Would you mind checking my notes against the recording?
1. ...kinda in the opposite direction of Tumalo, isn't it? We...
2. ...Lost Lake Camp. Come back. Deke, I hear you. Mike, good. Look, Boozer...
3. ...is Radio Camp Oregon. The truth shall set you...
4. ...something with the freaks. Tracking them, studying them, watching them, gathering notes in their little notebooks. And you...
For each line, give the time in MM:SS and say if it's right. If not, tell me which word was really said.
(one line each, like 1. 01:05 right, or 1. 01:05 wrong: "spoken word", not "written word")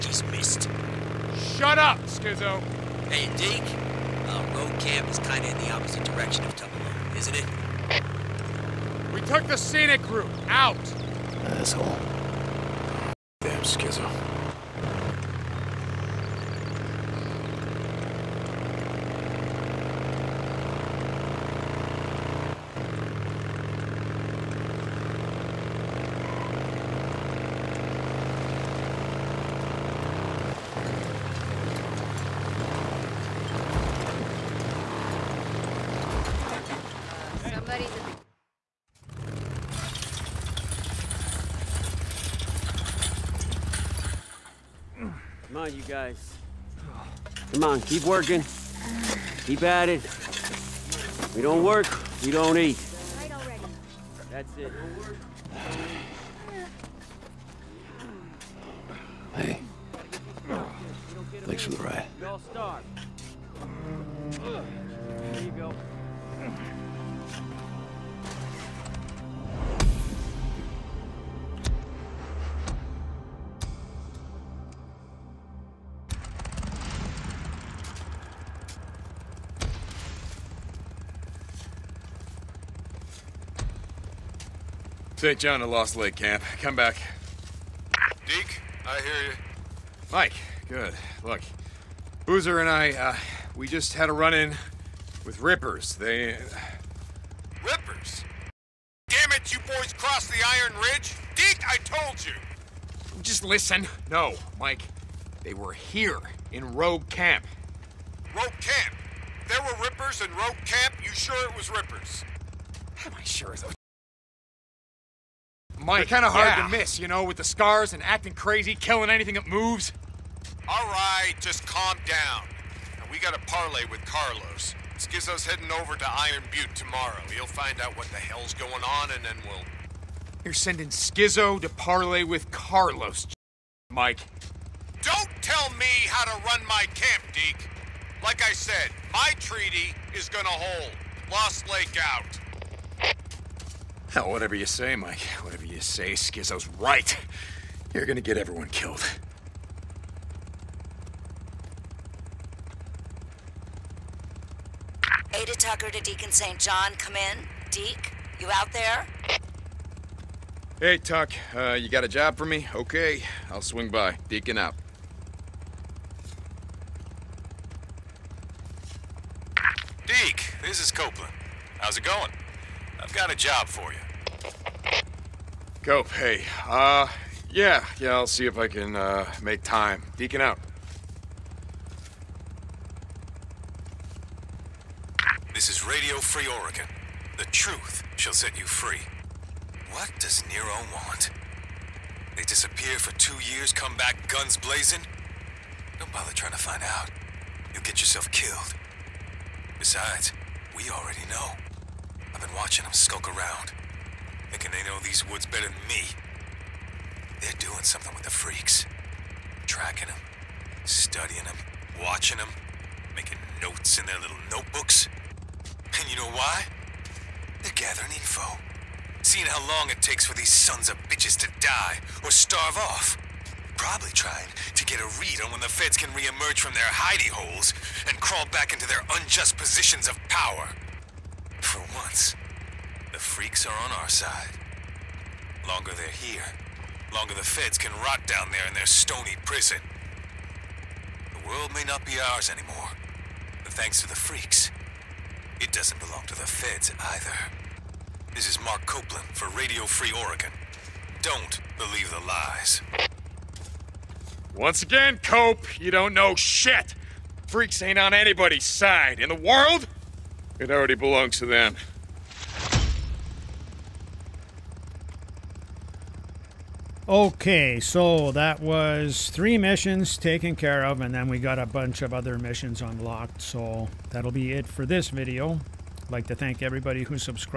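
1. 00:05 right
2. 01:25 right
3. 03:05 wrong: "Free", not "Camp"
4. 03:27 wrong: "making", not "gathering".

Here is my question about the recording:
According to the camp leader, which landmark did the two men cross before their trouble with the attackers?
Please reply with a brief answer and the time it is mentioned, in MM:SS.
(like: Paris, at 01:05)
Iron Ridge, at 01:40.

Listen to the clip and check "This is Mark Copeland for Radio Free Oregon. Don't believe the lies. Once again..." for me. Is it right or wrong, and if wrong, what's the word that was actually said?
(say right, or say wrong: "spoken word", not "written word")
right.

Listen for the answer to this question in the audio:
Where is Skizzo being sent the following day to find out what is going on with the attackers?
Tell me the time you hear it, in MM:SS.
02:06.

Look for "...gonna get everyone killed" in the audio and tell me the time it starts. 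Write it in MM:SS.
02:28.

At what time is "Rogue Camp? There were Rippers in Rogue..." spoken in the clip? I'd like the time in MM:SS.
01:48.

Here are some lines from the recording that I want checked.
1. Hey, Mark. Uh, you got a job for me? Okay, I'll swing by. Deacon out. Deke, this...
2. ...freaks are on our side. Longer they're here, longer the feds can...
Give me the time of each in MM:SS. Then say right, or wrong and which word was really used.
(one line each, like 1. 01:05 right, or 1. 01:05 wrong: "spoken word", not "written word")
1. 02:40 wrong: "Tuck", not "Mark"
2. 03:53 right.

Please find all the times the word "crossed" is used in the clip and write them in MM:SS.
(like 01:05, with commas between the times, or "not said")
01:39.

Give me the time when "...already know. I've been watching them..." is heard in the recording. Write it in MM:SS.
03:20.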